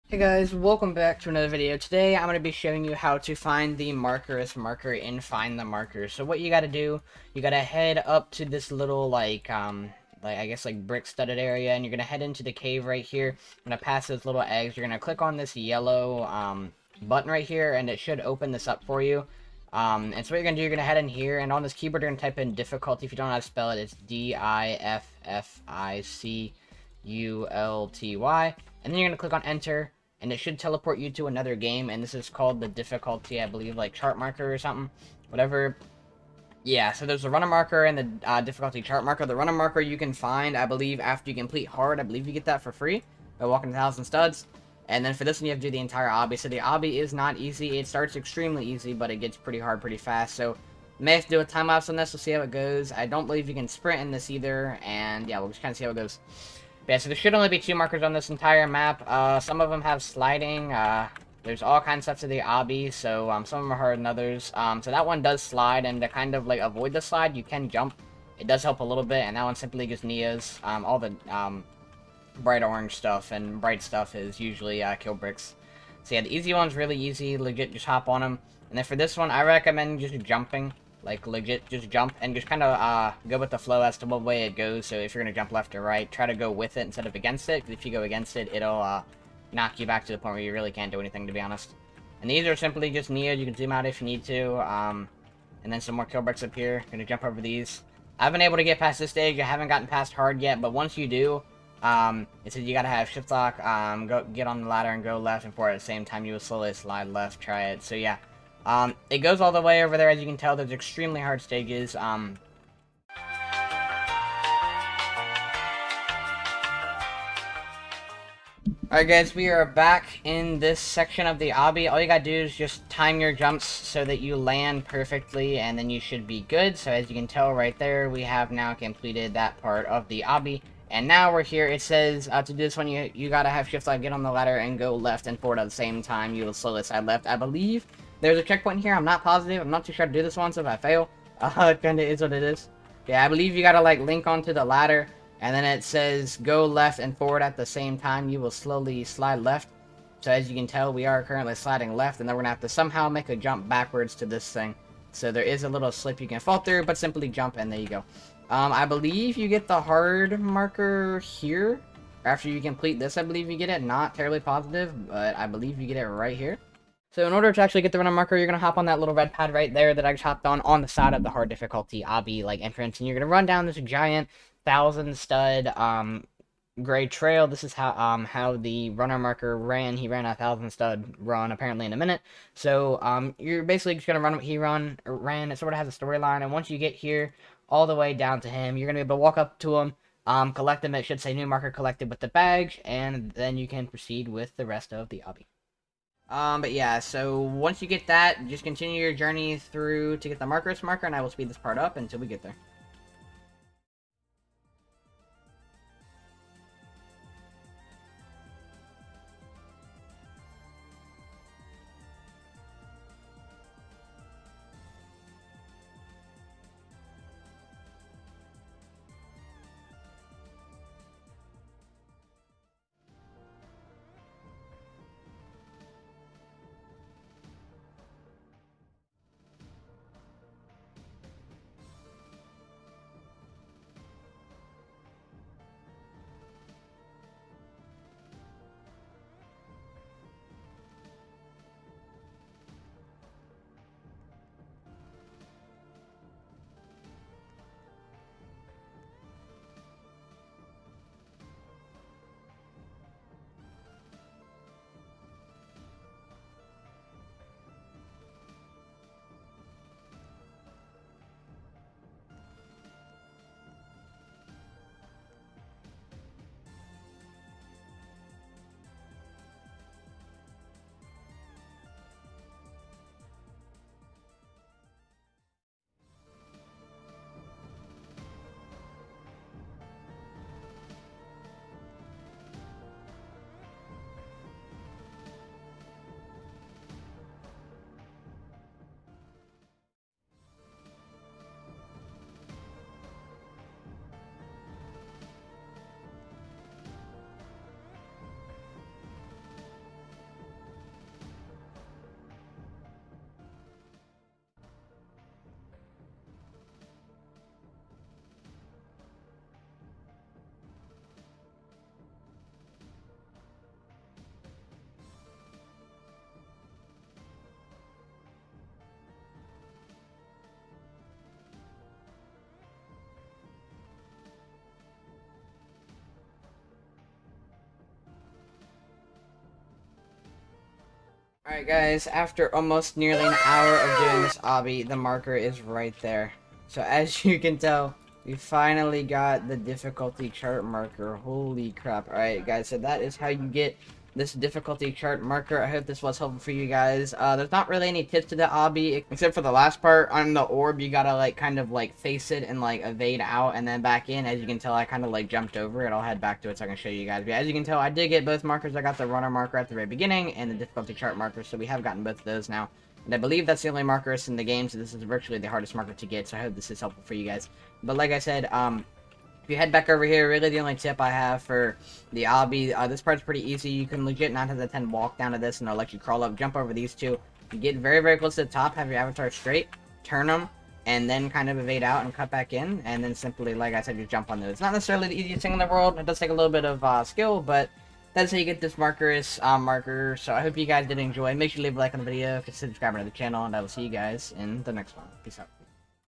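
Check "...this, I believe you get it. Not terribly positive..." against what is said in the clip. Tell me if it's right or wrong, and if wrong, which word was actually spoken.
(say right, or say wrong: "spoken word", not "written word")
right.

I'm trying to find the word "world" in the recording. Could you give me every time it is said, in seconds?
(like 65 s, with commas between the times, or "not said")
385 s.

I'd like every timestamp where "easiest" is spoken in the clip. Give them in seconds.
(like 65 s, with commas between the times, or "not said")
385 s.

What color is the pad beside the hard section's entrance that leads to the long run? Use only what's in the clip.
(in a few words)
red.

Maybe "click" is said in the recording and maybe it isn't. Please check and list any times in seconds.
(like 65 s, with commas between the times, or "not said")
14 s, 29 s.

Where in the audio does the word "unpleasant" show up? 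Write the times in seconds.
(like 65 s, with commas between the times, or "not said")
not said.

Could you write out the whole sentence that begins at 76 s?
So yeah, the easy one's really easy, legit, just hop on them.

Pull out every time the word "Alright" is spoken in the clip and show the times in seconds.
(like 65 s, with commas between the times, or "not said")
118 s, 331 s, 342 s.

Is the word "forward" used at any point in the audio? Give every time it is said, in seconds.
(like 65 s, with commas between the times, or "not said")
105 s, 135 s, 147 s.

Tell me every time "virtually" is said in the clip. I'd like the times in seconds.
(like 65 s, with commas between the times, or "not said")
365 s.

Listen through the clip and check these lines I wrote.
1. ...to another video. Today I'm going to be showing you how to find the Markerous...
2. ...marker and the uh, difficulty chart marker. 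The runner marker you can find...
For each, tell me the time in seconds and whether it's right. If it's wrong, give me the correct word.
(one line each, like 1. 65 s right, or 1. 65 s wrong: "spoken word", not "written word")
1. 1 s right
2. 37 s right.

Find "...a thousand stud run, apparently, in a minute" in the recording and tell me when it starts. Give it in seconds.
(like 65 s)
180 s.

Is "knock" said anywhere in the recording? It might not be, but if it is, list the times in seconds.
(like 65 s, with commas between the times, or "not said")
89 s.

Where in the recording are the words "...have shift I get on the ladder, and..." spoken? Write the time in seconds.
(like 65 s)
133 s.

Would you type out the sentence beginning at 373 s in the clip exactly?
You can legit 9 out of 10 walk down to this and they'll let you crawl up, jump over these two.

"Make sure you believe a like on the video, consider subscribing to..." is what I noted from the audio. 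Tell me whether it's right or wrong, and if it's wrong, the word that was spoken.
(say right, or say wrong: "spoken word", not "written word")
wrong: "leave", not "believe".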